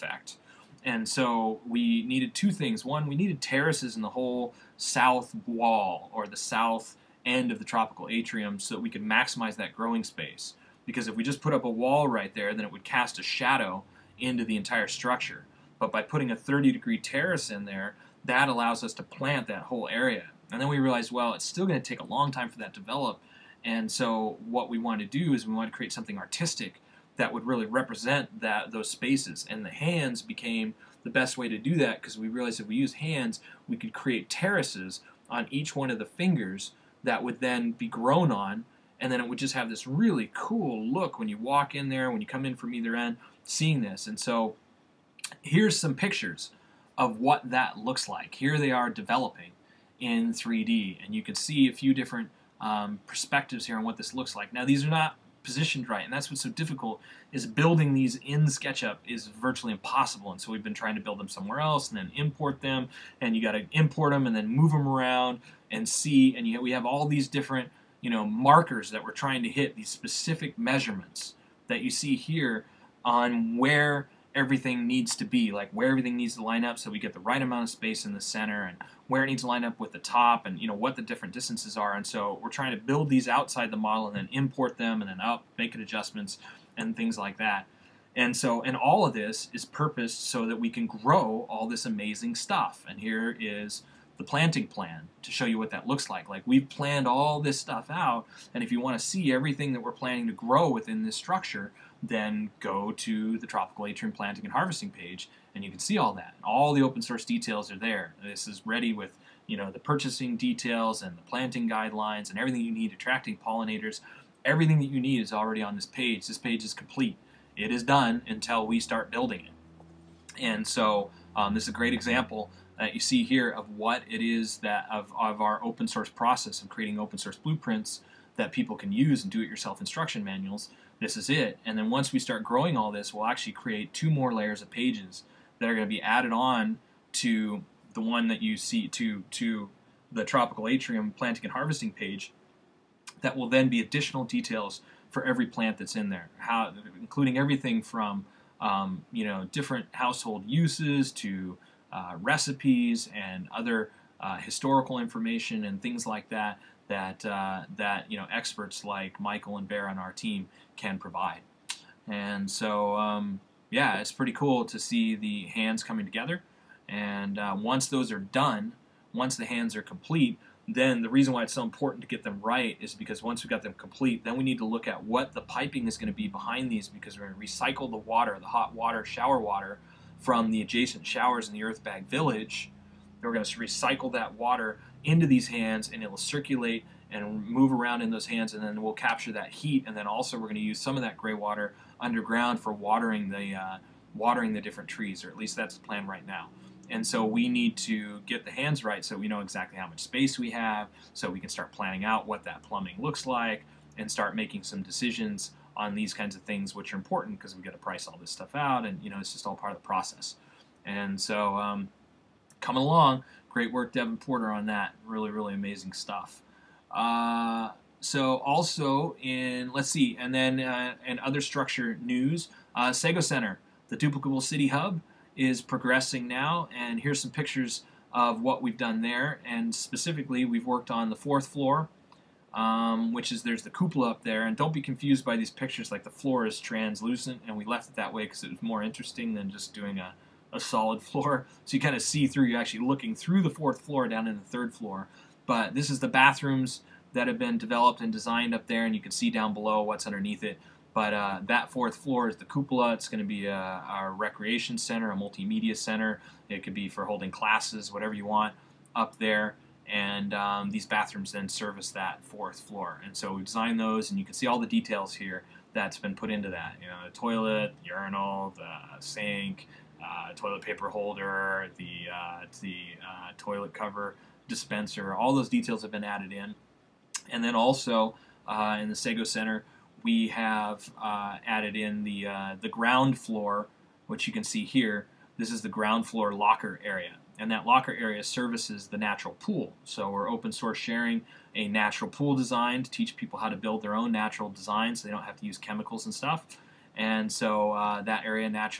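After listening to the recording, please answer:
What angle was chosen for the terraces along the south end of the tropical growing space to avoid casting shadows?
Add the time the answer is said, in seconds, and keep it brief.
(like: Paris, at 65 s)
30 degrees, at 16 s.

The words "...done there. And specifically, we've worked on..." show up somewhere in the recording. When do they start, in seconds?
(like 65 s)
228 s.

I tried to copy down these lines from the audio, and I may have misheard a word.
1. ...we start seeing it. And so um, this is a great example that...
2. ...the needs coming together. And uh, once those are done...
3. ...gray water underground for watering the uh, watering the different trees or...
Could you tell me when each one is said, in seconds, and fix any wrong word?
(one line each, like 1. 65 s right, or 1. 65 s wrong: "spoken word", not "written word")
1. 118 s wrong: "building", not "seeing"
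2. 165 s wrong: "hands", not "needs"
3. 191 s right.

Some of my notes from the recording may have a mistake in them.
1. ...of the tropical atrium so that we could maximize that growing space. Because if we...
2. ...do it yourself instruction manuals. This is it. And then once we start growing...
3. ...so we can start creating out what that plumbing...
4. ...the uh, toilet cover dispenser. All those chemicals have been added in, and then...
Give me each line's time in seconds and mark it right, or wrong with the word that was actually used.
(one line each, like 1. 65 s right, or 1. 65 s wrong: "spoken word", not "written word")
1. 7 s right
2. 129 s right
3. 201 s wrong: "planning", not "creating"
4. 272 s wrong: "details", not "chemicals".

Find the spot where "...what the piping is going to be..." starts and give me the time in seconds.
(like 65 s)
175 s.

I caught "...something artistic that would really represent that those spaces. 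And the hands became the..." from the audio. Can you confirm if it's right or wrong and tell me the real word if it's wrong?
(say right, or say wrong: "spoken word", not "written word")
right.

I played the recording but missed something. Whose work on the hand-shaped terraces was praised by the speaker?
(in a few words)
Devin Porter.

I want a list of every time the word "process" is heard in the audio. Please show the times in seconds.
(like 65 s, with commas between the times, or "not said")
126 s, 209 s.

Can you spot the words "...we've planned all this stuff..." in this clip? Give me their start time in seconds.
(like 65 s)
96 s.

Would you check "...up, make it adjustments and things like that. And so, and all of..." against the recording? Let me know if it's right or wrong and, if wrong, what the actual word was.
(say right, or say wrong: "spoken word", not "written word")
right.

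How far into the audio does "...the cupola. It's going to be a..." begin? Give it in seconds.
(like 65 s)
252 s.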